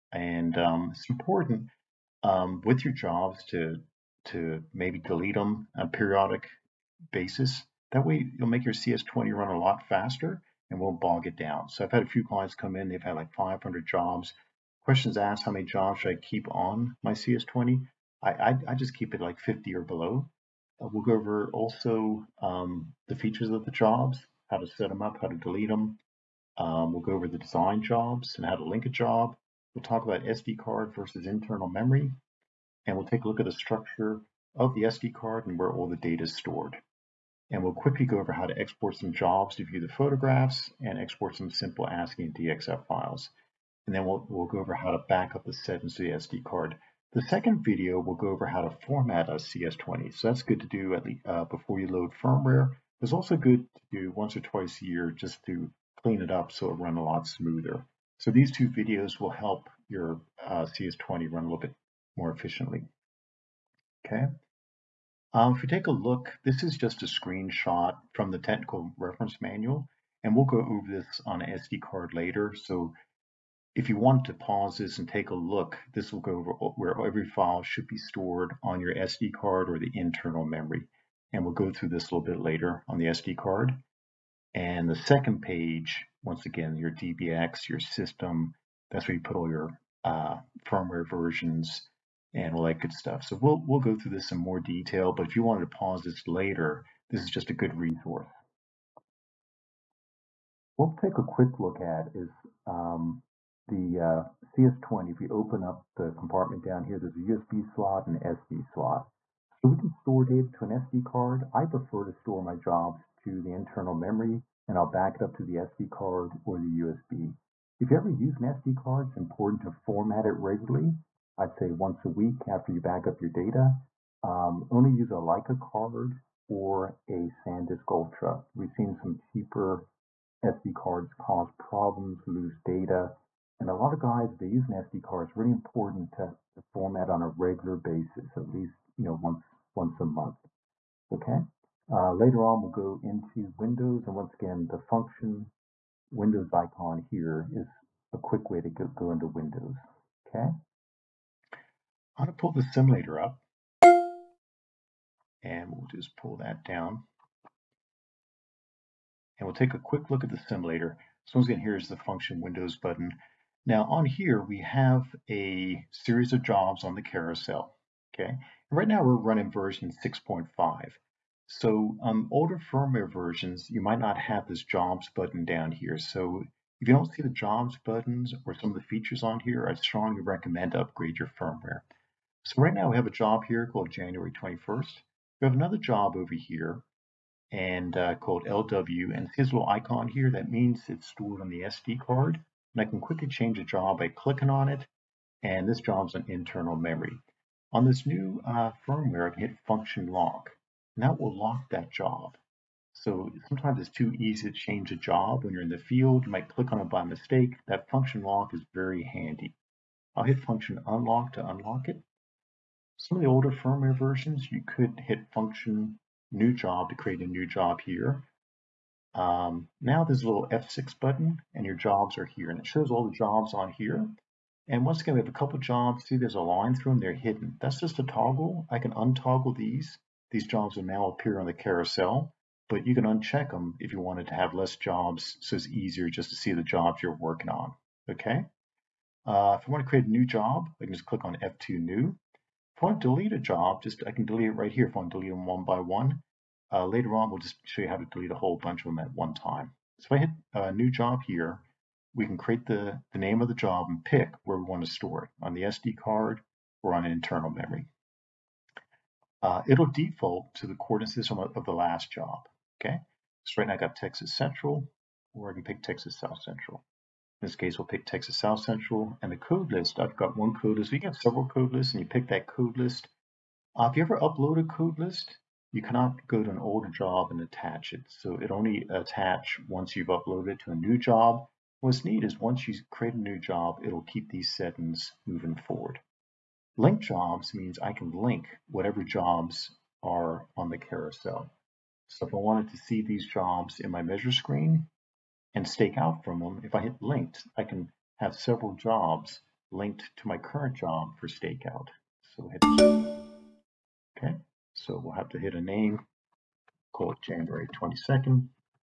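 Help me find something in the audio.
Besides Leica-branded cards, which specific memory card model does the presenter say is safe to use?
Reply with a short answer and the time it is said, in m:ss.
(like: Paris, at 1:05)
SanDisk Ultra, at 2:07.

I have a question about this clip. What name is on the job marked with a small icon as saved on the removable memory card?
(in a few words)
LW.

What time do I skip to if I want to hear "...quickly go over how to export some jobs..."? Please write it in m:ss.
0:37.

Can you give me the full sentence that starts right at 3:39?
Um, now there's a little F6 button and your jobs are here and it shows all the jobs on here.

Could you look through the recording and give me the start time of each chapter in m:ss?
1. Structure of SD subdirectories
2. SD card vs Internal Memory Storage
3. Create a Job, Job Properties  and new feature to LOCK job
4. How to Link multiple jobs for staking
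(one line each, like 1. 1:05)
1. 1:04
2. 1:49
3. 2:34
4. 4:49.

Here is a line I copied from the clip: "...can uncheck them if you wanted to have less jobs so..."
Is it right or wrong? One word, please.
right.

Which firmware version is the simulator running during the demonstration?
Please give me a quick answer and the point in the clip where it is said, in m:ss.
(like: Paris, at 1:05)
6.5, at 2:50.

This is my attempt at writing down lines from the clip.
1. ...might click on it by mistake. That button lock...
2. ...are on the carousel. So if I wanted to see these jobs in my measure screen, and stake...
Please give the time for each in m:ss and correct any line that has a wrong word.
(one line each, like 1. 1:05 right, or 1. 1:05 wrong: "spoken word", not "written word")
1. 3:26 wrong: "function", not "button"
2. 4:50 right.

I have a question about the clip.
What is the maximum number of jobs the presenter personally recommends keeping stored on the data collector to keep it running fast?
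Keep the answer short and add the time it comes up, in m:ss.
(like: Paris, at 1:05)
50, at 0:19.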